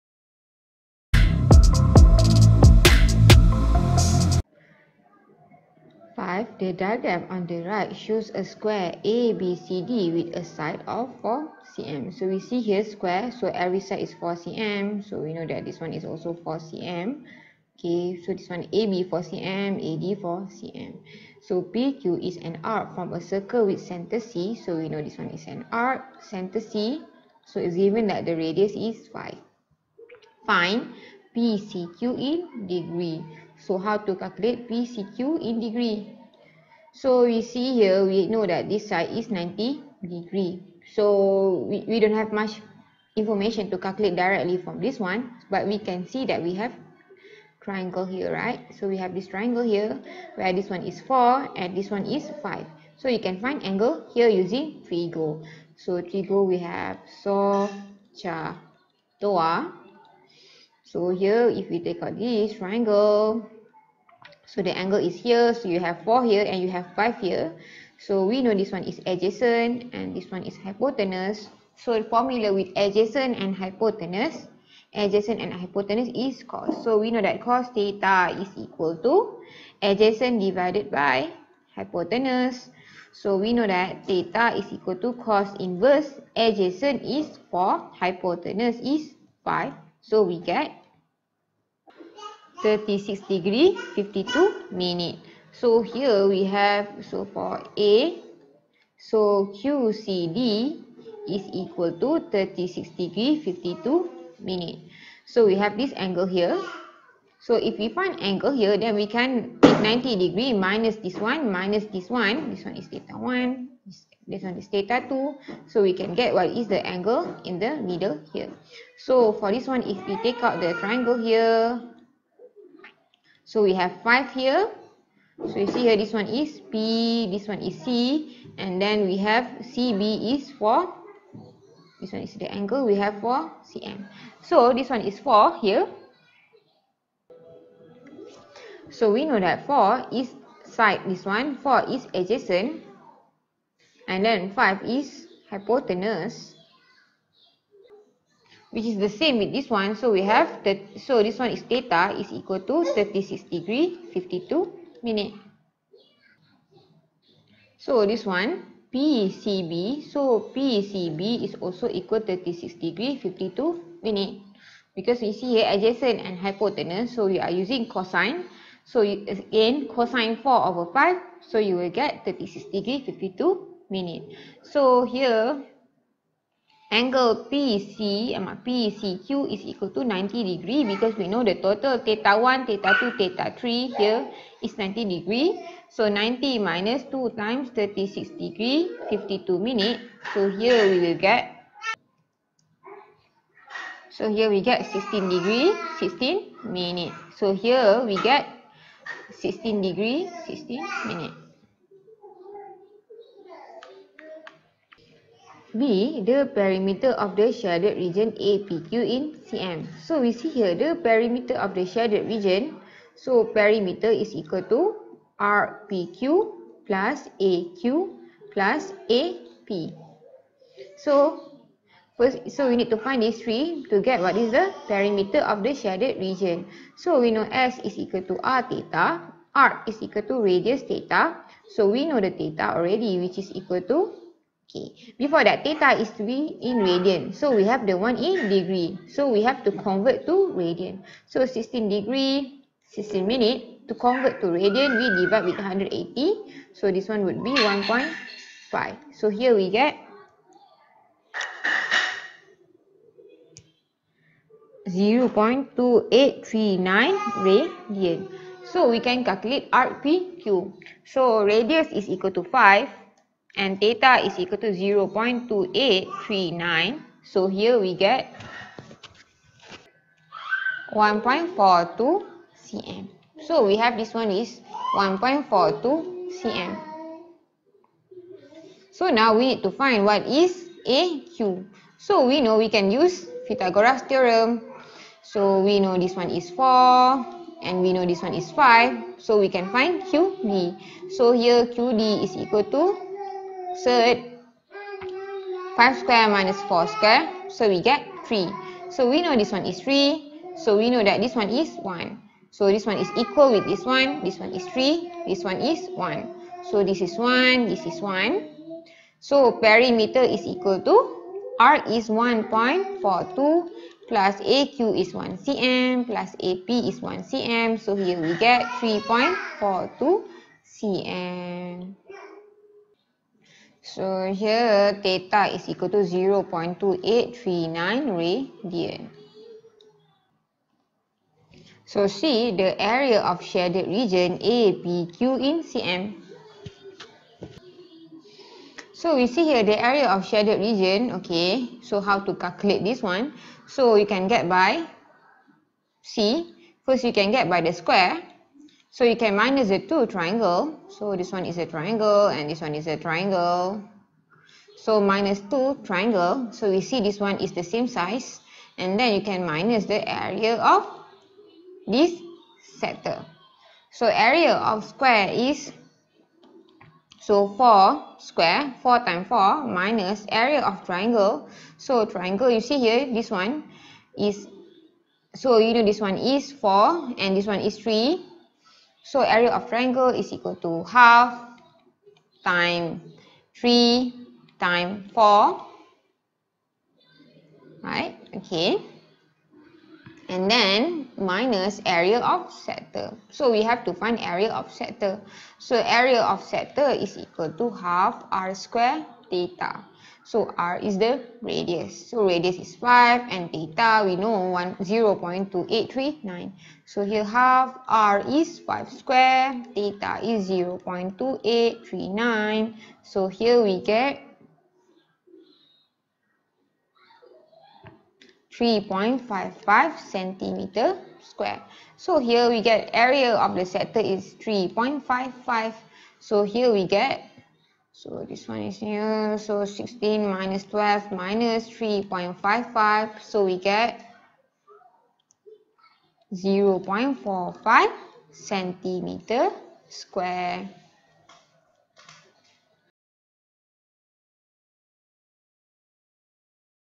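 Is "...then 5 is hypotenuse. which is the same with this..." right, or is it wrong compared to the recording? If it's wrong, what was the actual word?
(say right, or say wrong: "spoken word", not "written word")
right.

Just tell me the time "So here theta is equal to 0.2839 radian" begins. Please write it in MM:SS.
05:23.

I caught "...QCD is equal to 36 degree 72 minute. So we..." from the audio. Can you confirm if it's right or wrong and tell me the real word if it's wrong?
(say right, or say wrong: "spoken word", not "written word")
wrong: "52", not "72".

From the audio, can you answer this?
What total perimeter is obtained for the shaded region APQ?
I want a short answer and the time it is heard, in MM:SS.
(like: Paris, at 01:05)
3.42 cm, at 05:18.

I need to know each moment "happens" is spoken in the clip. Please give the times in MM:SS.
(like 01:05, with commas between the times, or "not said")
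not said.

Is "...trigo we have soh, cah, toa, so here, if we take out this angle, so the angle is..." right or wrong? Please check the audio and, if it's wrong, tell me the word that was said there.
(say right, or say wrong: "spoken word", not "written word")
wrong: "triangle", not "angle".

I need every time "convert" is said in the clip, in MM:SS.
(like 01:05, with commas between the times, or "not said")
03:59, 04:03.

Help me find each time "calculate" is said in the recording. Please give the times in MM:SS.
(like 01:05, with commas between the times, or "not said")
00:34, 00:43, 04:19, 05:42.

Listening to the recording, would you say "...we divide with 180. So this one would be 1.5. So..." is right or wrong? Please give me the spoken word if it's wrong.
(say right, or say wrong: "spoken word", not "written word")
right.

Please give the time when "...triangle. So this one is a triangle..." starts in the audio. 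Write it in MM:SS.
05:50.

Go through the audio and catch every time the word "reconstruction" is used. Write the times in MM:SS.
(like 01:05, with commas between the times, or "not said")
not said.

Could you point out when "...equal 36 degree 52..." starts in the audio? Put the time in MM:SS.
02:41.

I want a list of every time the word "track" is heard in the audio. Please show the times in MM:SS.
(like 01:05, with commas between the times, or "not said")
not said.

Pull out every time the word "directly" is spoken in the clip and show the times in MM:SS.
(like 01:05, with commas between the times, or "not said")
00:44.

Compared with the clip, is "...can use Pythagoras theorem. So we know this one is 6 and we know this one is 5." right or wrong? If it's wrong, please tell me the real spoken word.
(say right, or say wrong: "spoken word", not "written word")
wrong: "4", not "6".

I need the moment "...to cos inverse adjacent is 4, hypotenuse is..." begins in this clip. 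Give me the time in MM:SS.
01:24.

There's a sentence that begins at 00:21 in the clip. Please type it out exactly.
So PQ is an arc from a circle with center C.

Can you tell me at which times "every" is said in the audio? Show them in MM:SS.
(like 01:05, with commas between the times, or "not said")
00:13.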